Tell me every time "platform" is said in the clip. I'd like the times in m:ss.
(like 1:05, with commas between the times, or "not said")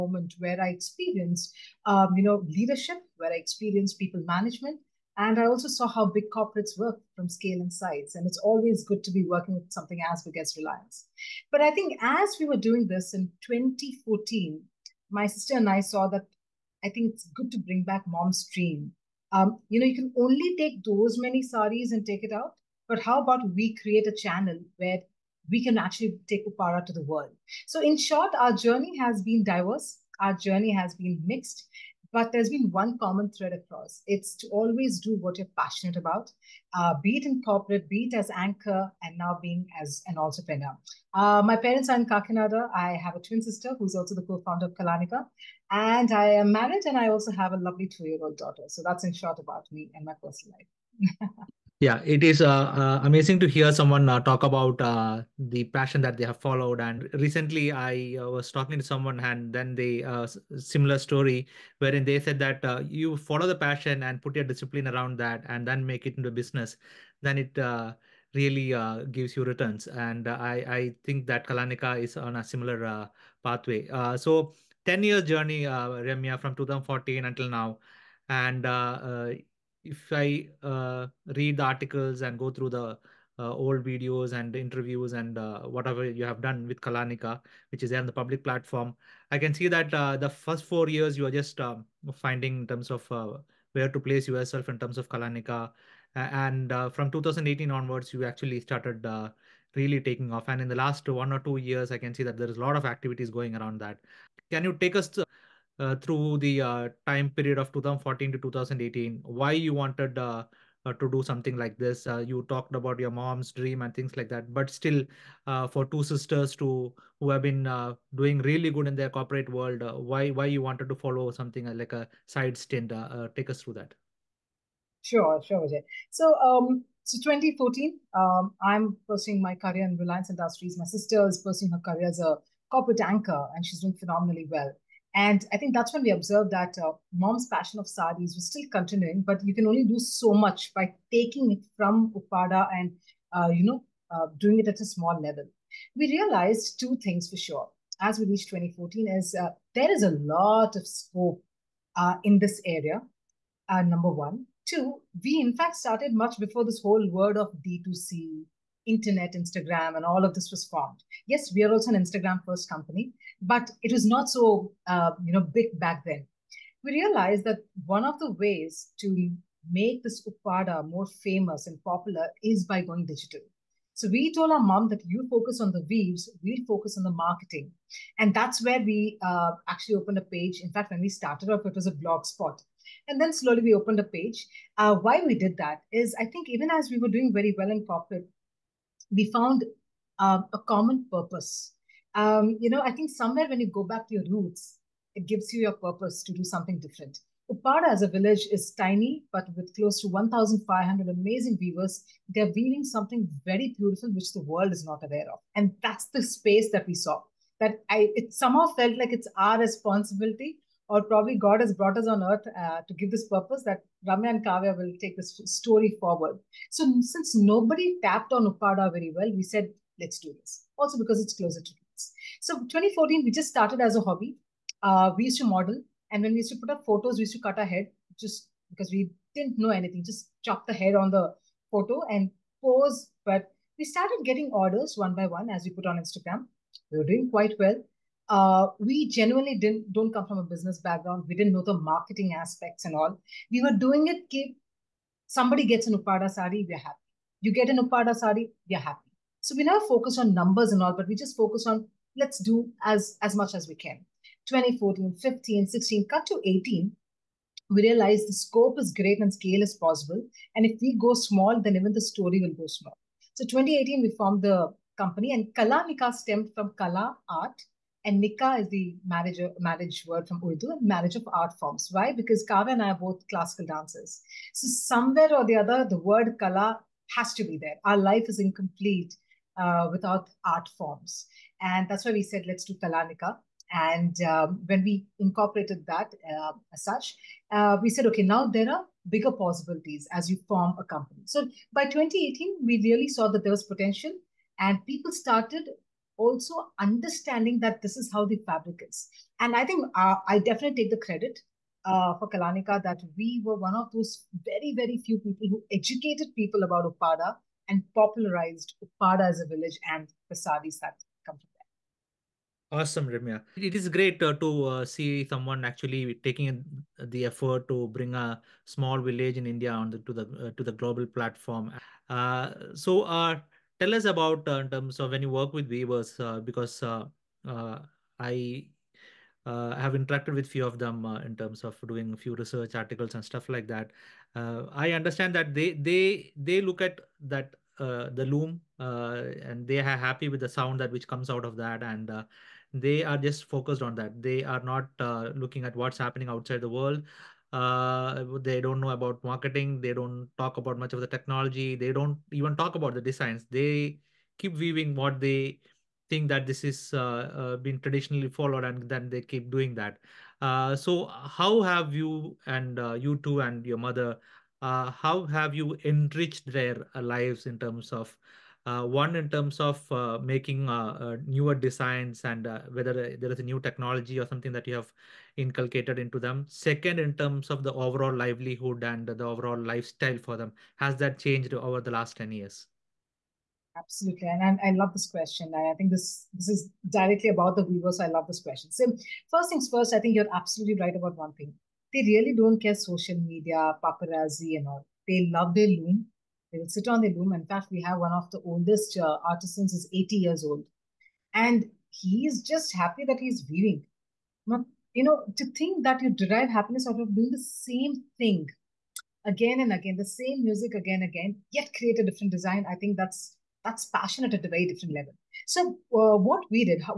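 1:28, 5:21.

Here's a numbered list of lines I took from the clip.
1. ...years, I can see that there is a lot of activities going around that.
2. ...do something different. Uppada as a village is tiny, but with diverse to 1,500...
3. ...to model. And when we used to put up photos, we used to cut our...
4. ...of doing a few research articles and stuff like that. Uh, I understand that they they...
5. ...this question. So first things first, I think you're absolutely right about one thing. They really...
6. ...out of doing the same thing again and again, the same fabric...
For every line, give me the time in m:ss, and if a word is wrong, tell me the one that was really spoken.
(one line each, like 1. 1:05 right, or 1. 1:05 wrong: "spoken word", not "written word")
1. 1:41 right
2. 3:16 wrong: "close", not "diverse"
3. 3:45 right
4. 5:31 right
5. 6:28 right
6. 6:46 wrong: "music", not "fabric".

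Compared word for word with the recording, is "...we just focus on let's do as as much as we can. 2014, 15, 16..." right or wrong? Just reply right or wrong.
right.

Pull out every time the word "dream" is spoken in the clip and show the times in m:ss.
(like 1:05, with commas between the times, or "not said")
0:18, 1:53.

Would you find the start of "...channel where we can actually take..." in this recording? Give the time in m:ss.
0:24.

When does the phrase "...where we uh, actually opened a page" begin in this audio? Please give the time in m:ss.
2:58.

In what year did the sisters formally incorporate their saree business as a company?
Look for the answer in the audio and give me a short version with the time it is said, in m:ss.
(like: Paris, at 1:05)
2018, at 4:23.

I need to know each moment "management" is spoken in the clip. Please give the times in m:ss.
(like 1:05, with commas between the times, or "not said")
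0:04.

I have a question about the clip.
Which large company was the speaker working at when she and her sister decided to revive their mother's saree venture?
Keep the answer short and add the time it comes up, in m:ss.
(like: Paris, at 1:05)
Reliance Industries, at 2:09.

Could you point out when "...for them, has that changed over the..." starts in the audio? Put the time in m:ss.
6:20.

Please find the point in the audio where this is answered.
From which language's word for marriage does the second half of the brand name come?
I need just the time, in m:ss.
4:30.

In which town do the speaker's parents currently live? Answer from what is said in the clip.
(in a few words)
Kakinada.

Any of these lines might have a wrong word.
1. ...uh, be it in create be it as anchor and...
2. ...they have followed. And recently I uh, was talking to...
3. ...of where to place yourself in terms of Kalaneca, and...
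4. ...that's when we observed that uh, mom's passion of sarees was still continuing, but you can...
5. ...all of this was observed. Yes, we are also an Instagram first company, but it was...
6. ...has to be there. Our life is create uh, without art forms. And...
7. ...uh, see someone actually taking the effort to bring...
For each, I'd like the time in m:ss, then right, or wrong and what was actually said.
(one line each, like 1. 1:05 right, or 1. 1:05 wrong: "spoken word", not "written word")
1. 0:36 wrong: "corporate", not "create"
2. 0:56 right
3. 1:32 right
4. 2:15 right
5. 2:40 wrong: "formed", not "observed"
6. 4:37 wrong: "incomplete", not "create"
7. 5:14 right.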